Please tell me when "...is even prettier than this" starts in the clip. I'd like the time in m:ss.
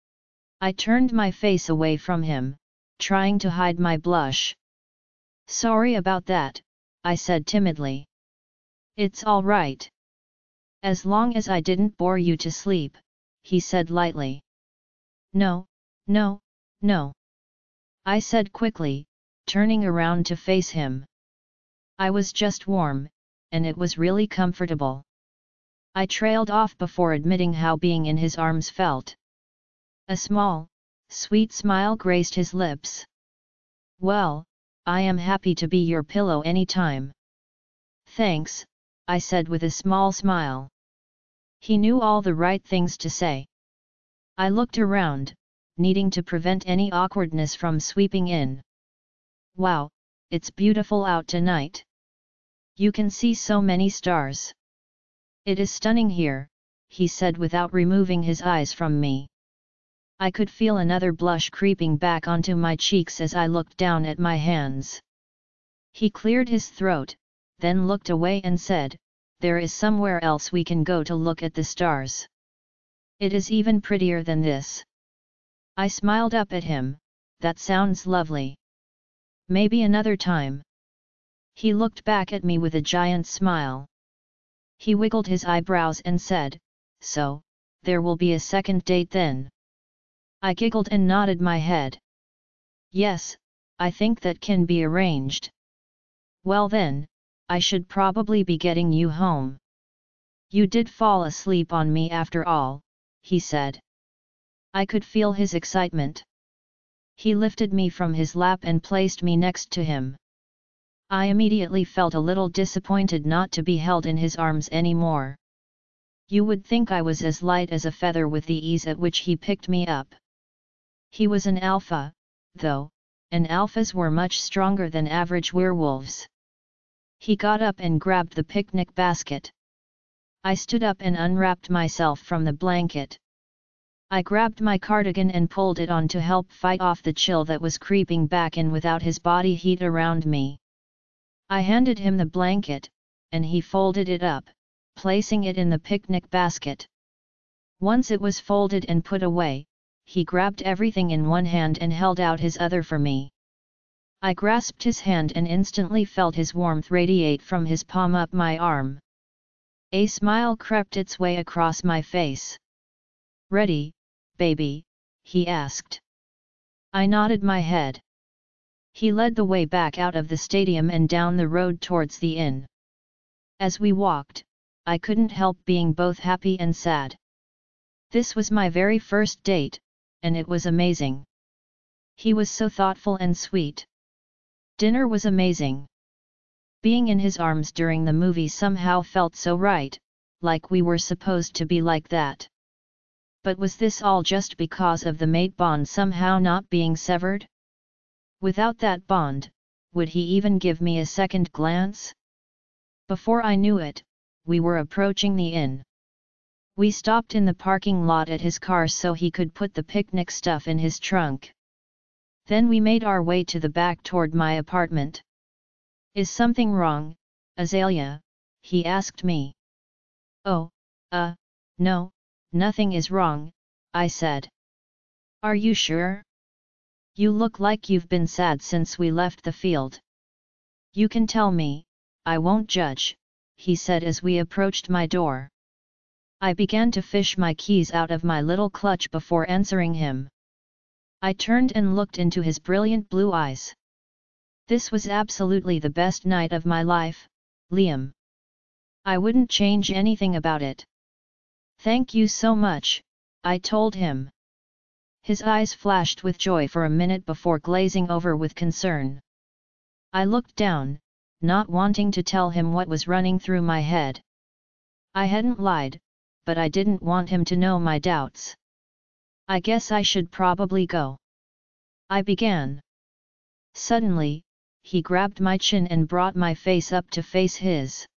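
1:13.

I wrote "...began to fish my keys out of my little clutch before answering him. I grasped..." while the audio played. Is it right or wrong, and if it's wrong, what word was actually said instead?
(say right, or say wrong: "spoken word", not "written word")
wrong: "turned", not "grasped".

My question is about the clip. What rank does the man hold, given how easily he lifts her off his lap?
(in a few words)
Alpha.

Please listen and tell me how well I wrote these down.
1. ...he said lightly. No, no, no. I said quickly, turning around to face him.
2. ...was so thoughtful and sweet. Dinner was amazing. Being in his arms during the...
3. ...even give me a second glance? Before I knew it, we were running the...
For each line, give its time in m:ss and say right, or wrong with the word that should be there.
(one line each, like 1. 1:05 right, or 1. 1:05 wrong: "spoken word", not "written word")
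1. 0:13 right
2. 3:02 right
3. 3:20 wrong: "approaching", not "running".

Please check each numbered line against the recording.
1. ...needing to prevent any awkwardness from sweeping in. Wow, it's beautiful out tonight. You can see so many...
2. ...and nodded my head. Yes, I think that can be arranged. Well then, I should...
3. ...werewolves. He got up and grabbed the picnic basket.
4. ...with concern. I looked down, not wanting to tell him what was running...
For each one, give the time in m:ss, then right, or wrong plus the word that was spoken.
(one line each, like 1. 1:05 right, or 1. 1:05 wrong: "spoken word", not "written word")
1. 0:45 right
2. 1:30 right
3. 2:05 right
4. 4:18 right.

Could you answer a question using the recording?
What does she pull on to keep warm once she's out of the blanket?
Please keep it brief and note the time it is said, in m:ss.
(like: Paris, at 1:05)
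Cardigan, at 2:14.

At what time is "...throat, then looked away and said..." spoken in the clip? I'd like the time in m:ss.
1:06.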